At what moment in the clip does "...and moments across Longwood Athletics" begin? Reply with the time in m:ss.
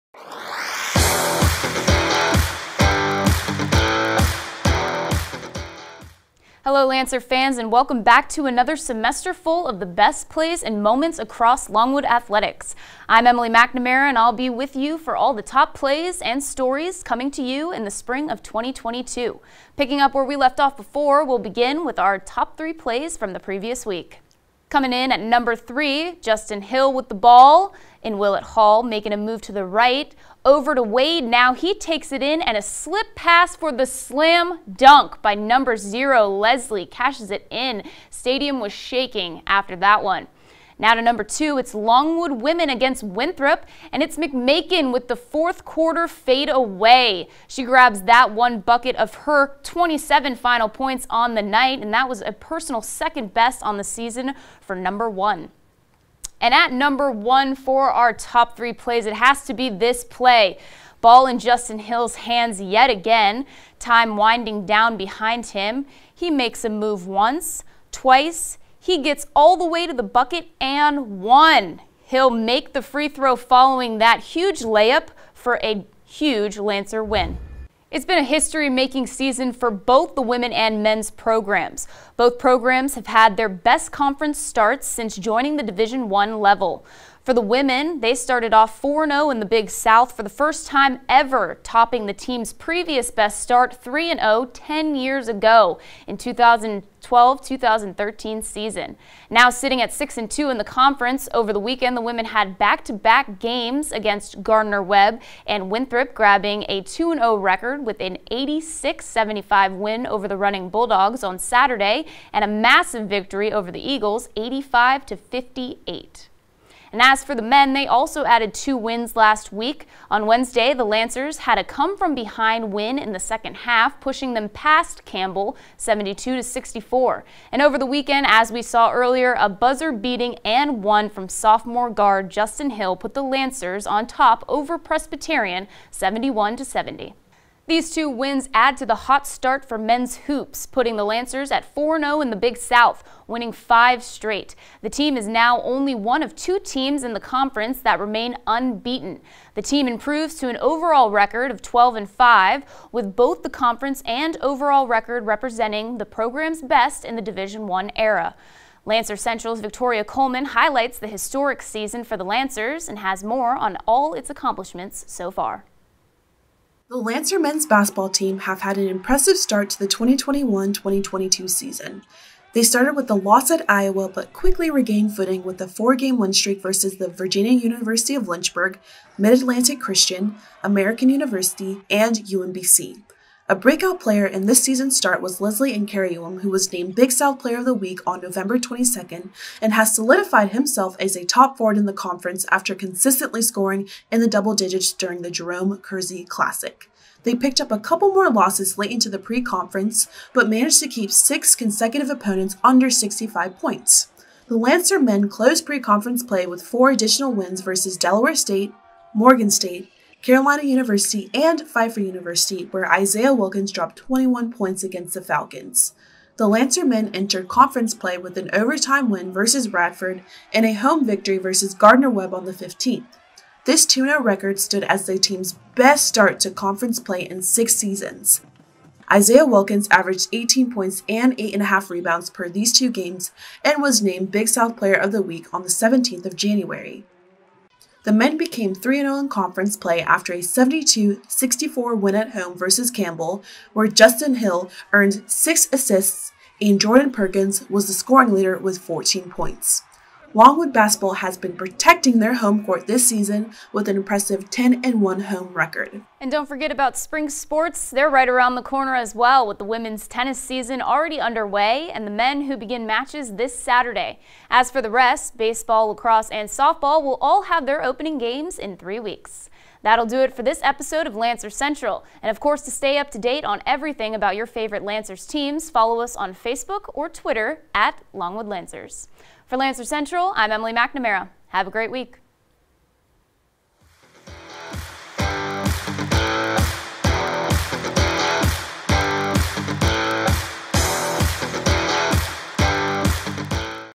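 0:10.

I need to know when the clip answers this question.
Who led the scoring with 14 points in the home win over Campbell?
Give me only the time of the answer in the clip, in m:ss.
4:06.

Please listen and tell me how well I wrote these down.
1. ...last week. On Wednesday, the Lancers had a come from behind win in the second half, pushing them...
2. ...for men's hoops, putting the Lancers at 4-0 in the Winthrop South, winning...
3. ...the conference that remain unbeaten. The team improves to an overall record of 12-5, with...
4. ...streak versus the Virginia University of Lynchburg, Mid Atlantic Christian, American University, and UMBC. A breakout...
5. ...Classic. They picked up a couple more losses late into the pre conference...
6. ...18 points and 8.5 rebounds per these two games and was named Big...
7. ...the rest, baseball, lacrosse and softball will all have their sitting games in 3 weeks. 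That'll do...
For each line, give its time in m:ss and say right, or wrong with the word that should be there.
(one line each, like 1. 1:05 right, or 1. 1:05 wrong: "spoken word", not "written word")
1. 1:59 right
2. 2:19 wrong: "Big", not "Winthrop"
3. 2:27 right
4. 2:56 right
5. 3:16 right
6. 3:50 right
7. 4:24 wrong: "opening", not "sitting".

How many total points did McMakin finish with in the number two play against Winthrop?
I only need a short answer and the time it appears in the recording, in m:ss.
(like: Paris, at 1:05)
27, at 0:49.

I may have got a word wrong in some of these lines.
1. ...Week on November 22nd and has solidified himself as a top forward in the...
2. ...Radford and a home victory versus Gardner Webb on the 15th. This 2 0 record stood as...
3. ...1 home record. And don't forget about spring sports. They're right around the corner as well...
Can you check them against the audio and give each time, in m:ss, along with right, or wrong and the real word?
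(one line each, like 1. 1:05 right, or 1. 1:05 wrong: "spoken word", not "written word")
1. 3:07 right
2. 3:39 right
3. 4:15 right.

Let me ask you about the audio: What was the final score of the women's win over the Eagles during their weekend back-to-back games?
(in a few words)
85-58.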